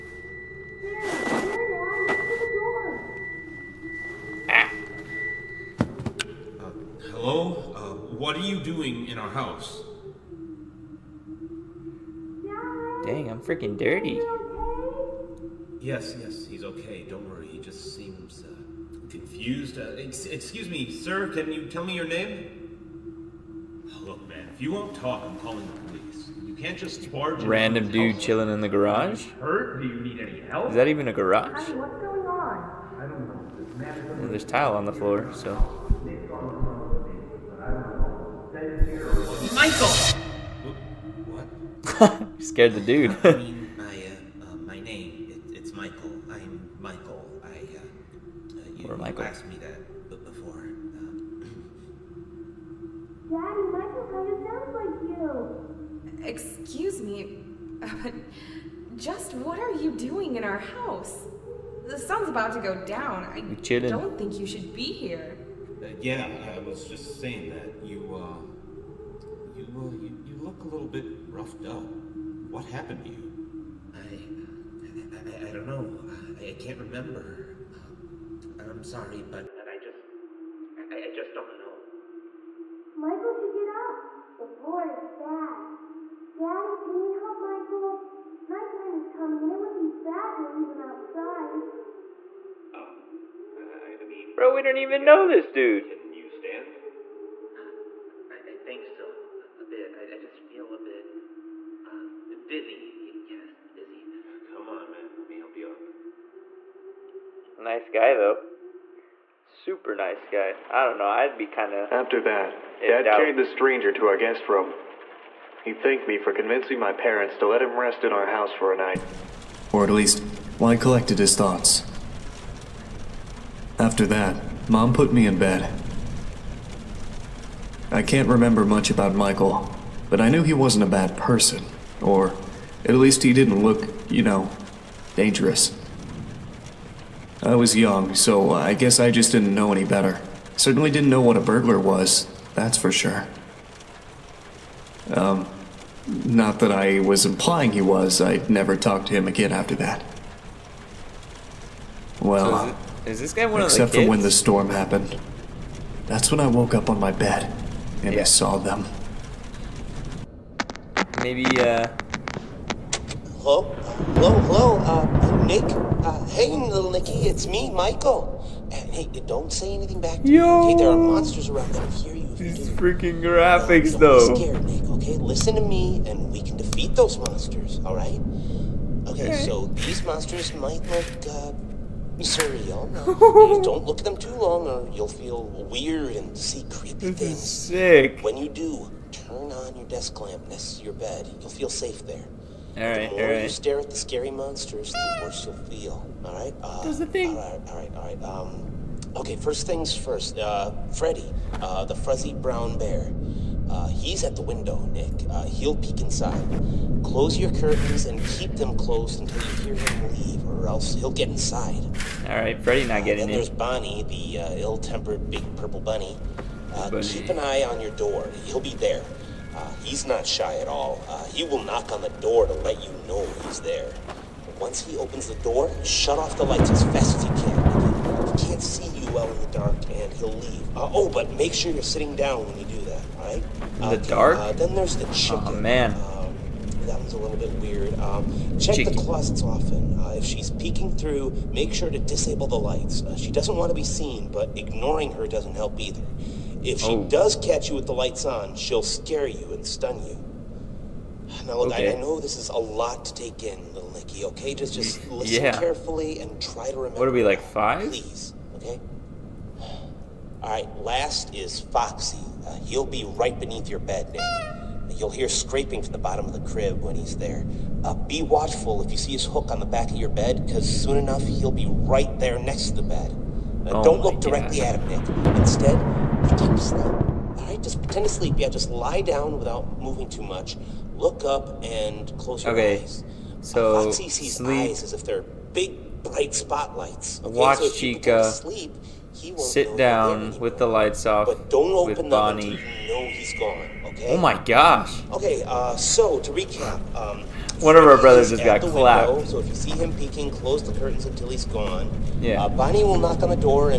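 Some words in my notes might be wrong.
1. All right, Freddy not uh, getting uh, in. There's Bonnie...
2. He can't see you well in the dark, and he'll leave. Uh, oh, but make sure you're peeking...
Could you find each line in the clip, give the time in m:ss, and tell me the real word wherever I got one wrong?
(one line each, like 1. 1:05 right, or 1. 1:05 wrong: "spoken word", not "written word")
1. 3:32 right
2. 3:48 wrong: "sitting", not "peeking".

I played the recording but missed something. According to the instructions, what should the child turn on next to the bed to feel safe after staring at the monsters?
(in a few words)
desk lamp.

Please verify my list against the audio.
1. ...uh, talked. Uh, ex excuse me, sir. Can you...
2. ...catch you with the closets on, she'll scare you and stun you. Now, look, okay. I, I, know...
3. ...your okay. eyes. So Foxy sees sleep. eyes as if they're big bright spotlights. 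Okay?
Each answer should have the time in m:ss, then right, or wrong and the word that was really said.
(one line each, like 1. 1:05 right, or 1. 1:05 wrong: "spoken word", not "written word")
1. 0:18 wrong: "confused", not "talked"
2. 4:07 wrong: "lights", not "closets"
3. 4:42 right.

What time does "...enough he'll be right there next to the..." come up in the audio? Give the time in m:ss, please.
4:30.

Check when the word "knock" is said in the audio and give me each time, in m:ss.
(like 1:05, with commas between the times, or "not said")
3:41, 5:02.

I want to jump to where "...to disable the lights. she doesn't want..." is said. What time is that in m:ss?
4:01.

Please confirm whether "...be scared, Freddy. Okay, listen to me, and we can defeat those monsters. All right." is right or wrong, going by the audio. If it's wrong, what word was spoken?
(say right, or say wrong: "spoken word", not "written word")
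wrong: "Nick", not "Freddy".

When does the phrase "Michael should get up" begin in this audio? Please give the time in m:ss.
1:22.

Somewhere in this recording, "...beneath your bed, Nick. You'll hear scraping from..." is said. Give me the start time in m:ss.
4:23.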